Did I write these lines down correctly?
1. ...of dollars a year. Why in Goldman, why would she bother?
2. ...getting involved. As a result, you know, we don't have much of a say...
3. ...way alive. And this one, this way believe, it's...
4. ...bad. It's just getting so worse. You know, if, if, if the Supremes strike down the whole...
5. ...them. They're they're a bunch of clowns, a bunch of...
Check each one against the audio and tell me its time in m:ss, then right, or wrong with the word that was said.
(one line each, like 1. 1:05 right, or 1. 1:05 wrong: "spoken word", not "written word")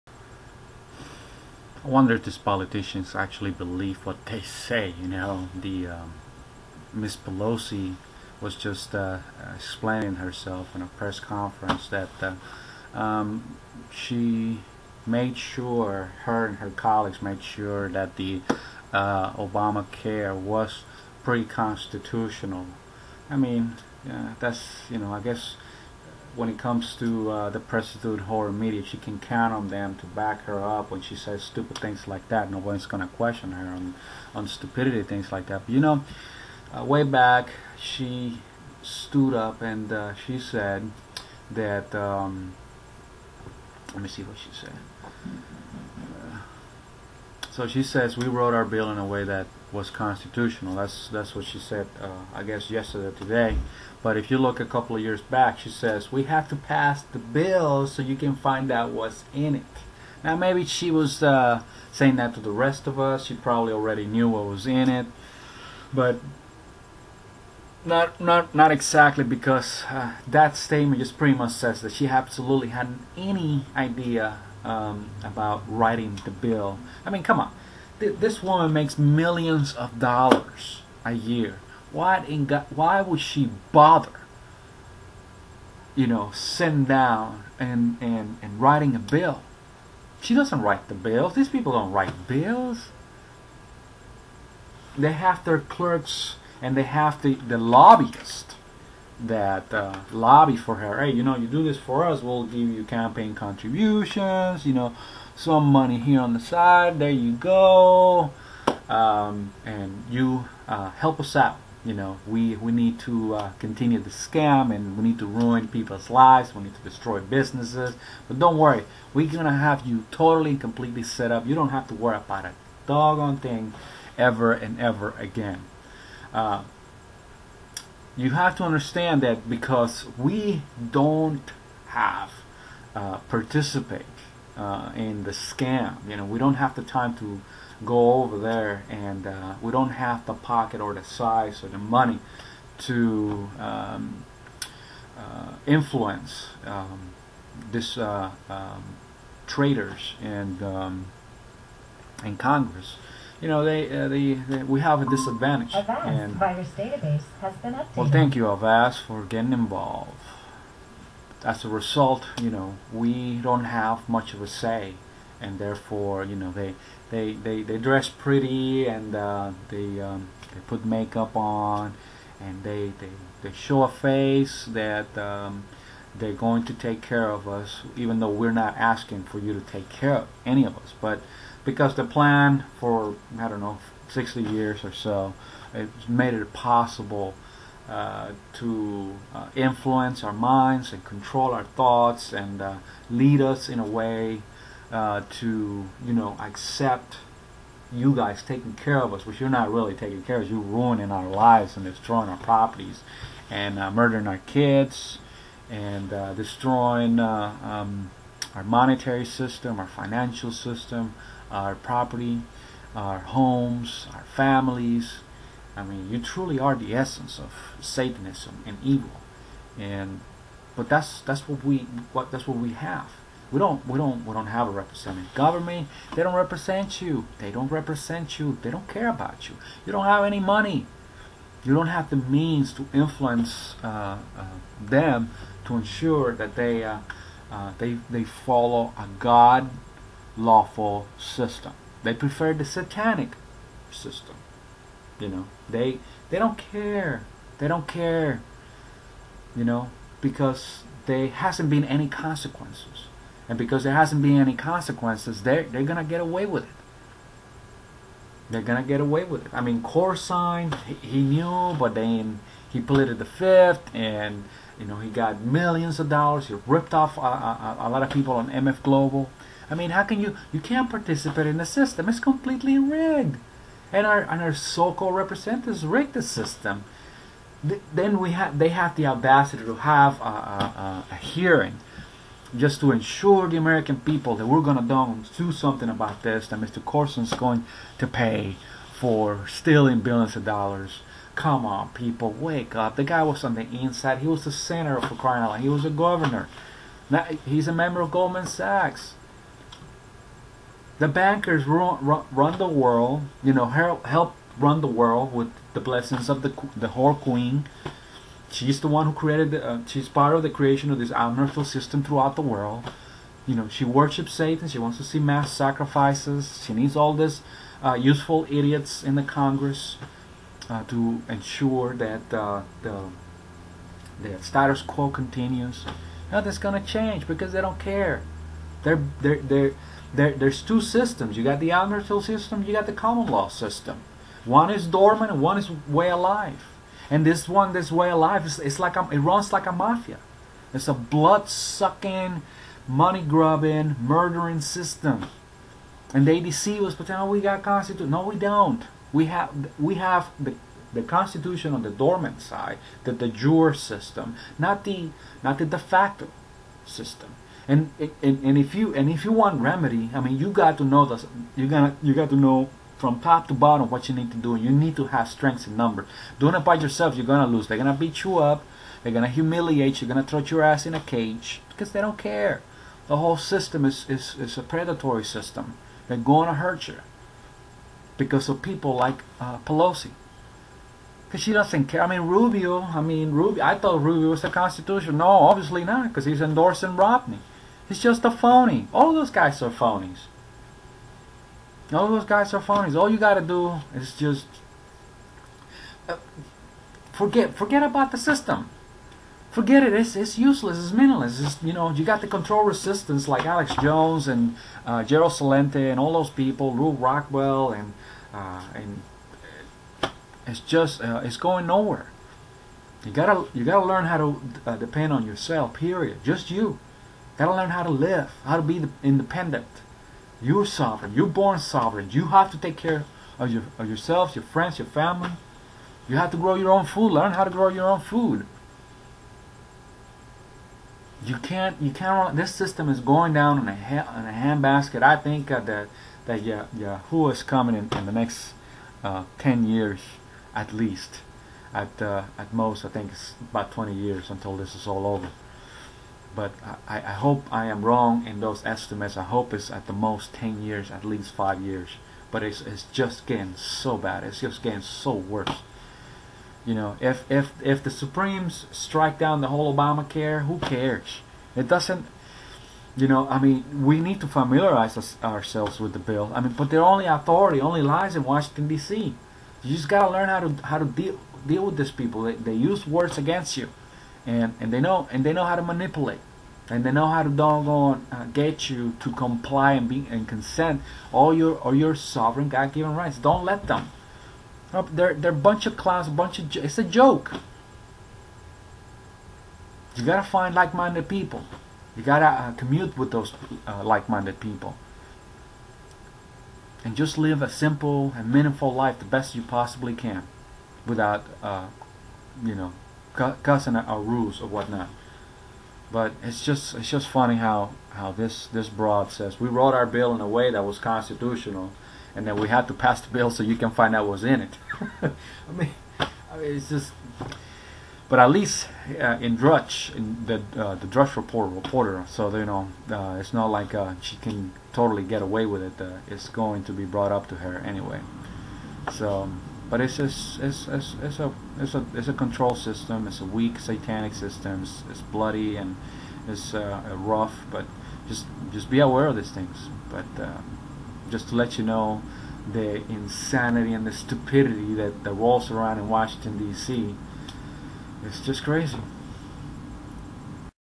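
1. 1:19 wrong: "God", not "Goldman"
2. 2:39 right
3. 5:35 wrong: "alive", not "believe"
4. 7:33 right
5. 8:03 right.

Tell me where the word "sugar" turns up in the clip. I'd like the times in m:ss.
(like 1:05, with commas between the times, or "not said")
not said.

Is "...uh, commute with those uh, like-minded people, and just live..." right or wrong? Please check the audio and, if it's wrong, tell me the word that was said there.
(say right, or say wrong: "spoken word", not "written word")
right.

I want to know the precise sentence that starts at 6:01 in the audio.
You gonna you got to know from top to bottom what you need to do.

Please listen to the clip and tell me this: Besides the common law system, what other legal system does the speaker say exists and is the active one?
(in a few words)
admiralty system.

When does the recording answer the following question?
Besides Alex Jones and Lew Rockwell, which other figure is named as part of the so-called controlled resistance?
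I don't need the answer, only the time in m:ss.
6:45.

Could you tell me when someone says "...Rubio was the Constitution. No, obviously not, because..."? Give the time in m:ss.
6:24.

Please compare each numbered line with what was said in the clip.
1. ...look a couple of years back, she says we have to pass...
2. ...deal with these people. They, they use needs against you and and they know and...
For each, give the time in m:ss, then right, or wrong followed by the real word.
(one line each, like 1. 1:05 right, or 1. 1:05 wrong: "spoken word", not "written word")
1. 0:54 right
2. 7:51 wrong: "words", not "needs".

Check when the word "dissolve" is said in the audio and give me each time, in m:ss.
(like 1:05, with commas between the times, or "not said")
not said.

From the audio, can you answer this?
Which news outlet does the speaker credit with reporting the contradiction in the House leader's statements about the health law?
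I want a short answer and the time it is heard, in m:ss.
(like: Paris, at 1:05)
Drudge Report, at 8:40.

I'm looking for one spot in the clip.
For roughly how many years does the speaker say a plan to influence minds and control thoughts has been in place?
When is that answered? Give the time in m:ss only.
3:04.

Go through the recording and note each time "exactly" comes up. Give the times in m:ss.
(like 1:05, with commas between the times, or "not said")
1:08.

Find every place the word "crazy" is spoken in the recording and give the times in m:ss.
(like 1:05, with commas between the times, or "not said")
9:08.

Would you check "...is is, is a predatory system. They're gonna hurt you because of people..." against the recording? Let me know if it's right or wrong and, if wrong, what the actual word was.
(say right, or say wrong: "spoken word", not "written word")
right.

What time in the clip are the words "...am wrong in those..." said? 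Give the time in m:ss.
7:27.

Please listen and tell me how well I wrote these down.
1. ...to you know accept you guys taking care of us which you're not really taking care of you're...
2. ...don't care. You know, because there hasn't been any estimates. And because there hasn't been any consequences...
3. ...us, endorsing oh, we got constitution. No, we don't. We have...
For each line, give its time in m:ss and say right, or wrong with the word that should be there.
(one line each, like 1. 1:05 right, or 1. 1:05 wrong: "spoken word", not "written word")
1. 3:15 right
2. 4:07 wrong: "consequences", not "estimates"
3. 5:46 wrong: "pretending", not "endorsing".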